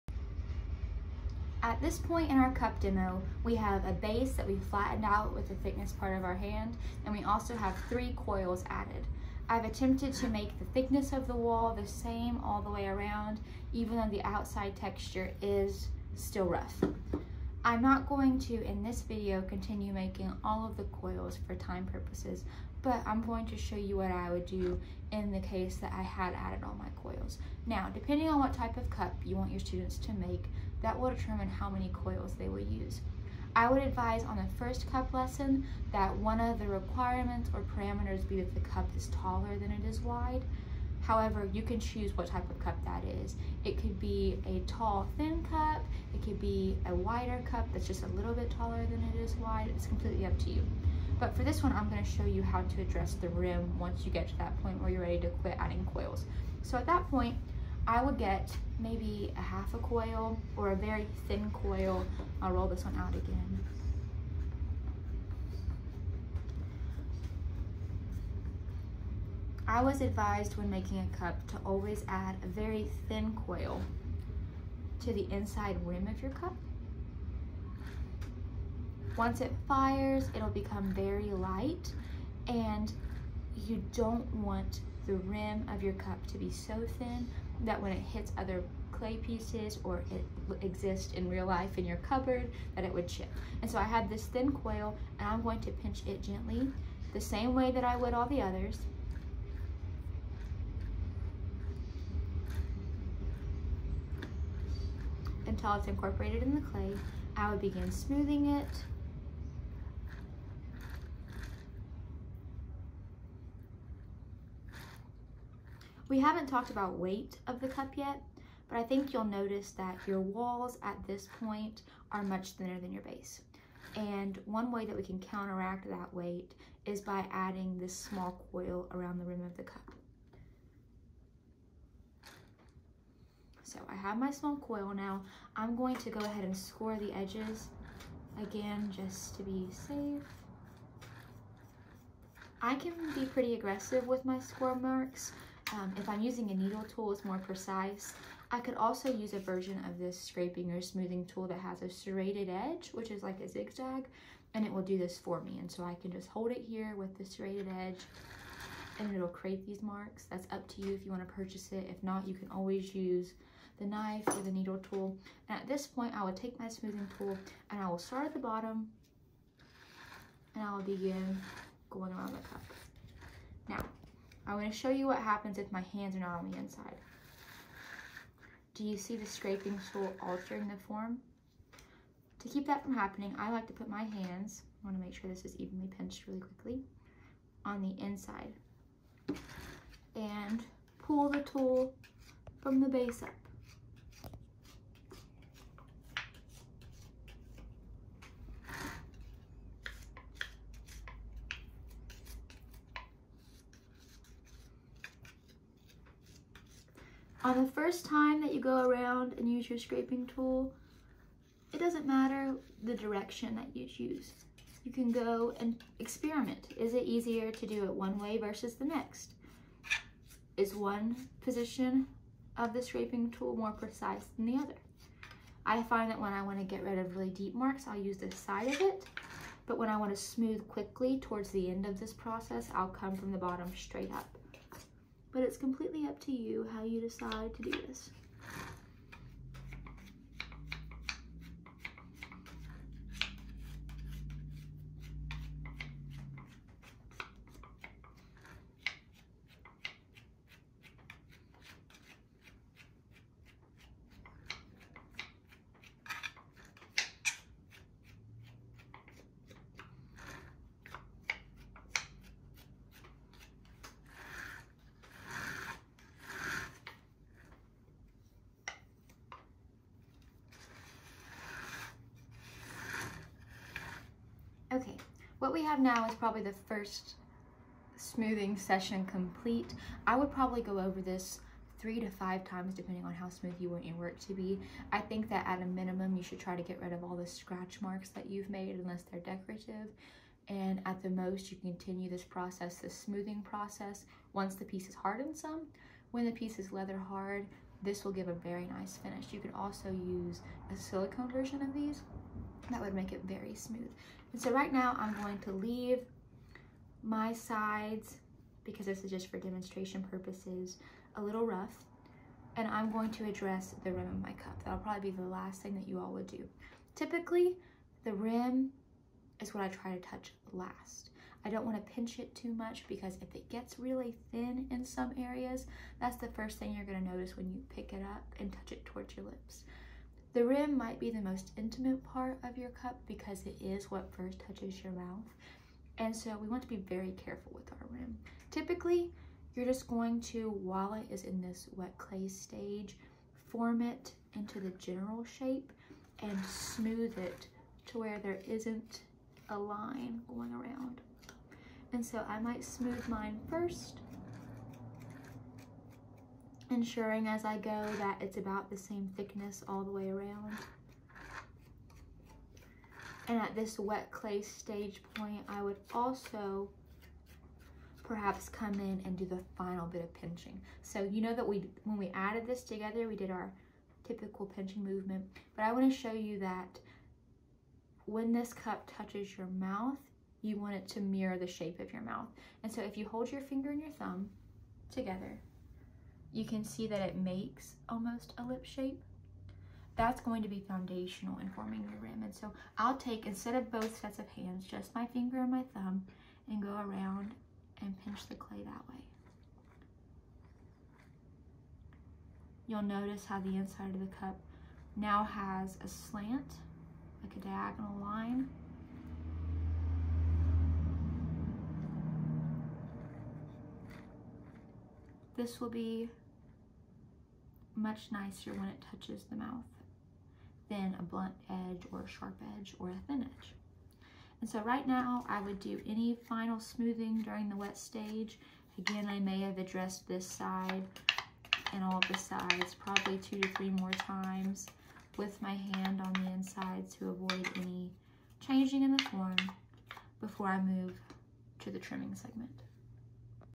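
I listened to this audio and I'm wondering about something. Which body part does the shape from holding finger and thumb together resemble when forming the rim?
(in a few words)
lip.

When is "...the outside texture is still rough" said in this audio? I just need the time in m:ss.
0:14.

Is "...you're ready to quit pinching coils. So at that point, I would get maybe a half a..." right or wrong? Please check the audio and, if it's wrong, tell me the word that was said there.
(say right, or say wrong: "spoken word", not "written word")
wrong: "adding", not "pinching".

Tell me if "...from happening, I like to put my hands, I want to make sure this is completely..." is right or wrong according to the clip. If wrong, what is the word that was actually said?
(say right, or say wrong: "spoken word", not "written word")
wrong: "evenly", not "completely".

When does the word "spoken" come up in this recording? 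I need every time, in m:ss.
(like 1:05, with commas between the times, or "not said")
not said.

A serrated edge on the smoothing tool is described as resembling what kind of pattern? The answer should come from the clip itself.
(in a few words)
zigzag.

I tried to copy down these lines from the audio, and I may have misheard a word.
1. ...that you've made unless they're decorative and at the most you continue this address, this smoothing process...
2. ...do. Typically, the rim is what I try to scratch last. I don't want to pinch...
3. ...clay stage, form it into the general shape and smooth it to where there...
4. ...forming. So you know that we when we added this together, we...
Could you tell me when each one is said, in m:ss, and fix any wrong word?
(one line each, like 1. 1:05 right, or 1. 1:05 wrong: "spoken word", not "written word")
1. 4:48 wrong: "process", not "address"
2. 5:16 wrong: "touch", not "scratch"
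3. 5:41 right
4. 6:10 wrong: "pinching", not "forming".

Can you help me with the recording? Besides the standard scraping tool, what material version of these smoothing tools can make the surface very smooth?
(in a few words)
silicone.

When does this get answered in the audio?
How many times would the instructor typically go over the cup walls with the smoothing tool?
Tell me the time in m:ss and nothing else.
4:41.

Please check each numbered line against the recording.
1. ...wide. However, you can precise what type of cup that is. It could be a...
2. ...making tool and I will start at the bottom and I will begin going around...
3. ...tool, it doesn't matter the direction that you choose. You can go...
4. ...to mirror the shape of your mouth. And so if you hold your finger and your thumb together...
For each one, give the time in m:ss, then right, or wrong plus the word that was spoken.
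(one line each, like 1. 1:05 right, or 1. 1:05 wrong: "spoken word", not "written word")
1. 0:39 wrong: "choose", not "precise"
2. 2:46 wrong: "smoothing", not "making"
3. 3:30 right
4. 6:20 right.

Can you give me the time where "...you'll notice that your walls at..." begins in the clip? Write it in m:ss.
1:59.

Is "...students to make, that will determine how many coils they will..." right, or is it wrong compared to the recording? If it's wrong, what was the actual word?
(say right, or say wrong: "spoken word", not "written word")
right.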